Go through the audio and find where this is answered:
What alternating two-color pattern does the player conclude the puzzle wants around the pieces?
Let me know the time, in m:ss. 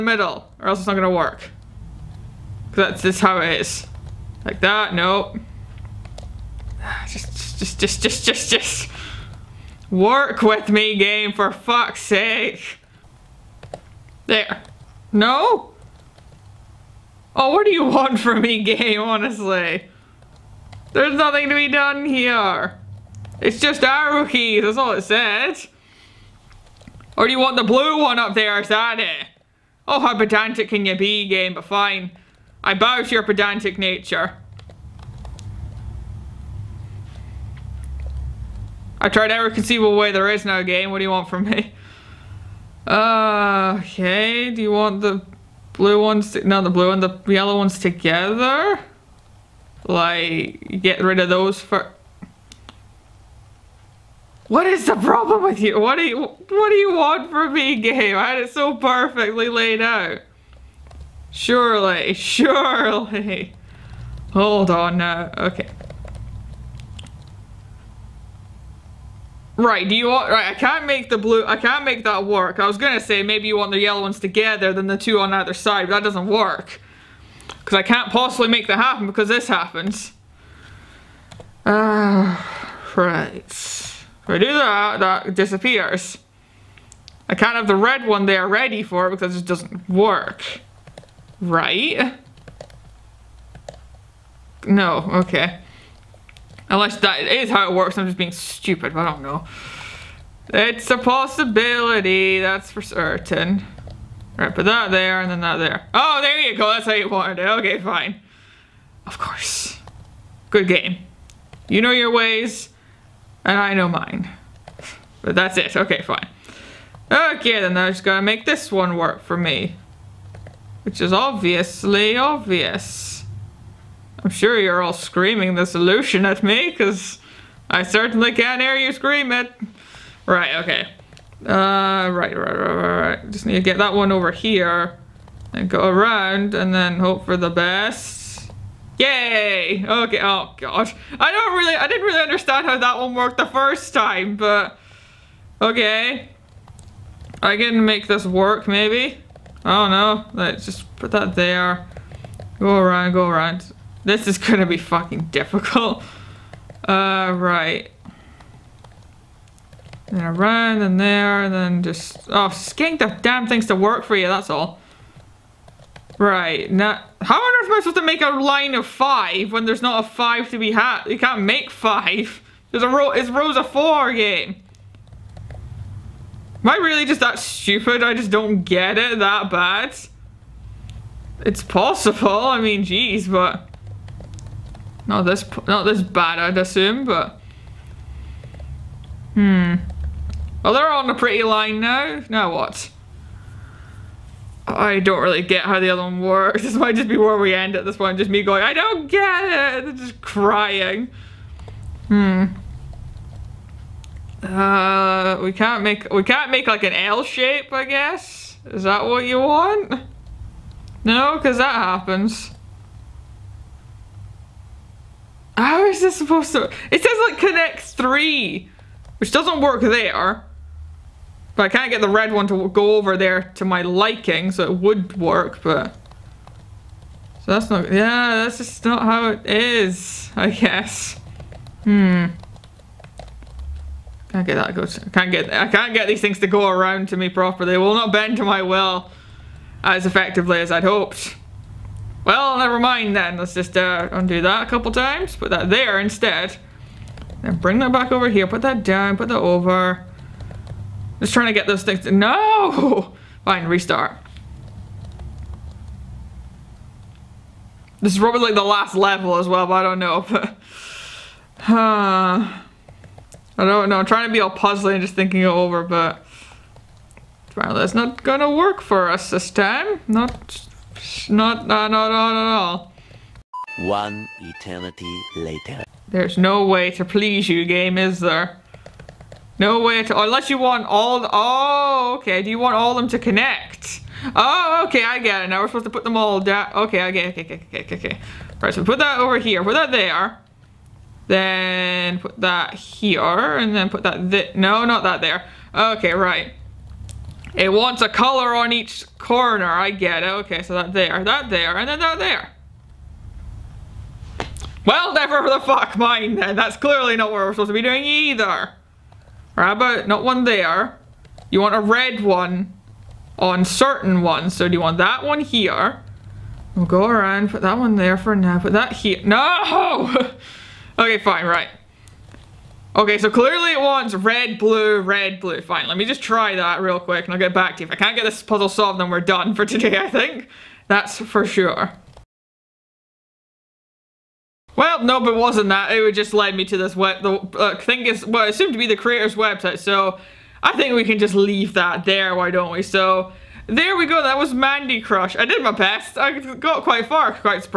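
5:24.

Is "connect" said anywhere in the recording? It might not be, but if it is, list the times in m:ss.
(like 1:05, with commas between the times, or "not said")
3:37, 4:43.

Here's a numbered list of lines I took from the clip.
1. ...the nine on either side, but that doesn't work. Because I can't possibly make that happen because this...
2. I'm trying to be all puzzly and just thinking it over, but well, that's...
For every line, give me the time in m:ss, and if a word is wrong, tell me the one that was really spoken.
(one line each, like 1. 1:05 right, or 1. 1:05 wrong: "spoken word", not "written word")
1. 1:14 wrong: "two", not "nine"
2. 4:23 right.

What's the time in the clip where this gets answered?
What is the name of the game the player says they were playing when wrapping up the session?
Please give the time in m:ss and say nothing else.
5:44.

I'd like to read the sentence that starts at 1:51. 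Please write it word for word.
You know your ways, and I know mine.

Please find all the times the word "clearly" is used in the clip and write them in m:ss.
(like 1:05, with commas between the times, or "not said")
5:06, 5:23.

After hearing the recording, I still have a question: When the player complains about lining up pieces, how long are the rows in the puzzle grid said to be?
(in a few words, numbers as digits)
4.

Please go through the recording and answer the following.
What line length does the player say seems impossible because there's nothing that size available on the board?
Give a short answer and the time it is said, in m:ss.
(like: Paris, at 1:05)
5, at 2:48.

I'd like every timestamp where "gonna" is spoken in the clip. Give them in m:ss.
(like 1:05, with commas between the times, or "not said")
0:00, 1:12, 2:34, 4:28.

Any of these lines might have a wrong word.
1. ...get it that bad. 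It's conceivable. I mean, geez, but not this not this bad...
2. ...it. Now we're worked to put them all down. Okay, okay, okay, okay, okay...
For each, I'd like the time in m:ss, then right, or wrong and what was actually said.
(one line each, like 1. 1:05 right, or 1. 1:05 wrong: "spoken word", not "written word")
1. 2:58 wrong: "possible", not "conceivable"
2. 4:45 wrong: "supposed", not "worked".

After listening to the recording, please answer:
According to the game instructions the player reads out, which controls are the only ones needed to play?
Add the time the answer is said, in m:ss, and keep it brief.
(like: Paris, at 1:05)
Arrow keys, at 0:23.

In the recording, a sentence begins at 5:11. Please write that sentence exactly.
You want a red one on certain ones.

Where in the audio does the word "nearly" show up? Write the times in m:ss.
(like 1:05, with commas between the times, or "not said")
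not said.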